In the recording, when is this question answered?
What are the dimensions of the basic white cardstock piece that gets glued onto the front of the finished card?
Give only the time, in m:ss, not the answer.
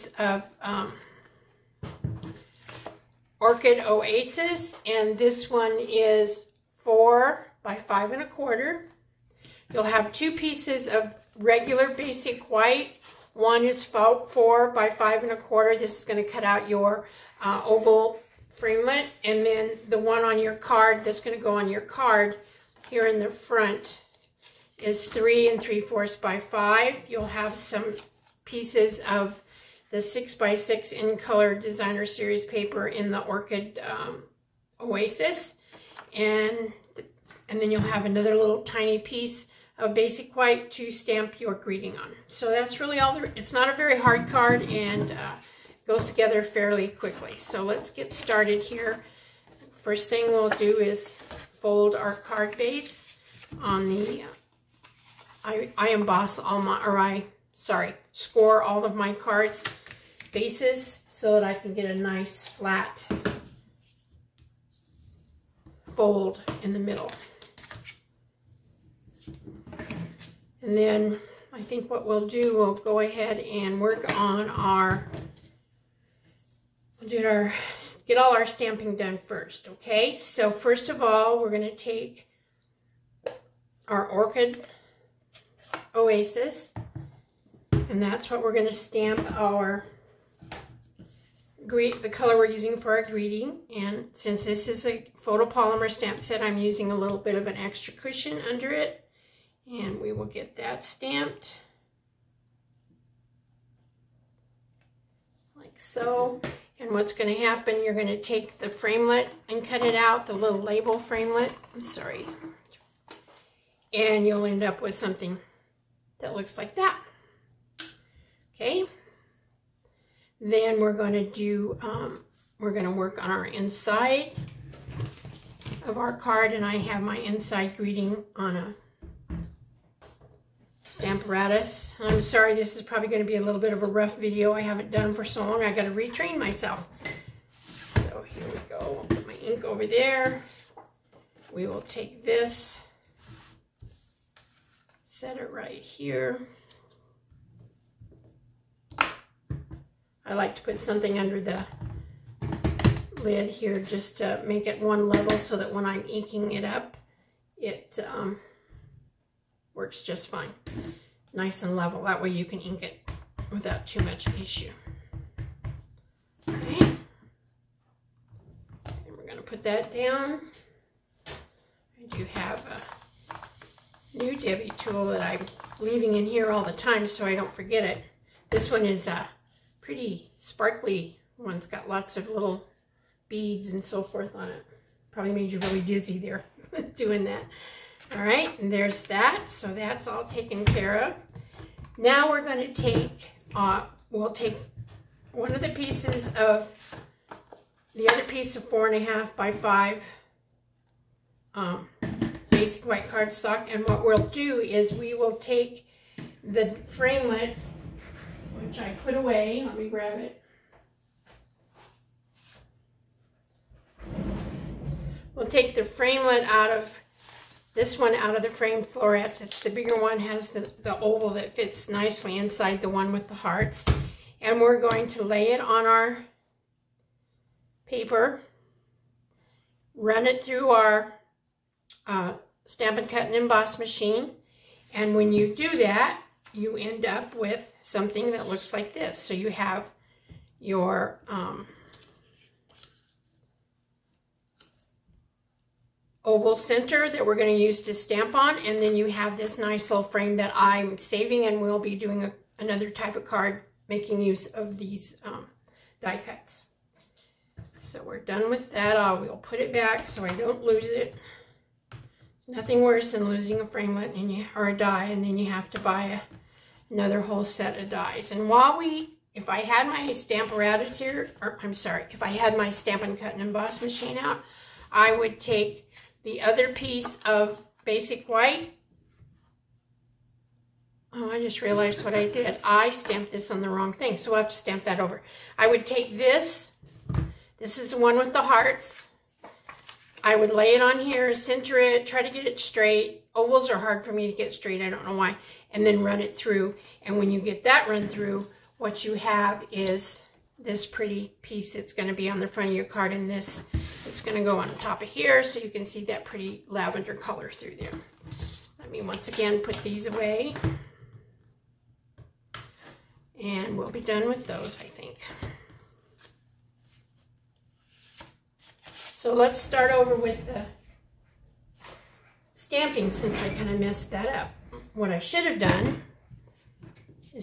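0:25.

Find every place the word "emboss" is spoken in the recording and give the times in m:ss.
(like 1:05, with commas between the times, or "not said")
0:55, 3:53, 4:33.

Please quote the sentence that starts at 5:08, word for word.
Let me once again put these away and we'll be done with those I think.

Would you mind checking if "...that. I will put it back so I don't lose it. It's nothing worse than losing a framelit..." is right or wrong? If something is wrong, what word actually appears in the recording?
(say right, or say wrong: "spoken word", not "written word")
right.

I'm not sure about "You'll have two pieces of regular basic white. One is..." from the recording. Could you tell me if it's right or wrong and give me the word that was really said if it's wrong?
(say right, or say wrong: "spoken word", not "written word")
right.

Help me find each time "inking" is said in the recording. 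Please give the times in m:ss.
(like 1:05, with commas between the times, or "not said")
2:36.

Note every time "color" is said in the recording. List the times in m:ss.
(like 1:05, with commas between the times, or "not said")
0:31, 1:32, 5:07.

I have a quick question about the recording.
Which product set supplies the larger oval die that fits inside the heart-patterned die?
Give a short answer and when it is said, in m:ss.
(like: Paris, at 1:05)
Framed Florets, at 3:38.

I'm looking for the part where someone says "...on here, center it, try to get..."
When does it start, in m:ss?
4:50.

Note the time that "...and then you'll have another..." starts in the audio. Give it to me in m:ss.
0:37.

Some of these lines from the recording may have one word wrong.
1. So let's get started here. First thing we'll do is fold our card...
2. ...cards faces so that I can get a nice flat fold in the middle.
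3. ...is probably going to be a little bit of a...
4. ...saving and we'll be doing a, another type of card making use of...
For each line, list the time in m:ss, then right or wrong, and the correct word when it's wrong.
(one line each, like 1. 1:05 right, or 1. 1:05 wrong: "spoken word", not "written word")
1. 0:47 right
2. 0:59 right
3. 2:12 right
4. 4:10 right.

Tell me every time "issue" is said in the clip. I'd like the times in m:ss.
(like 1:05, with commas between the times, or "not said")
2:44.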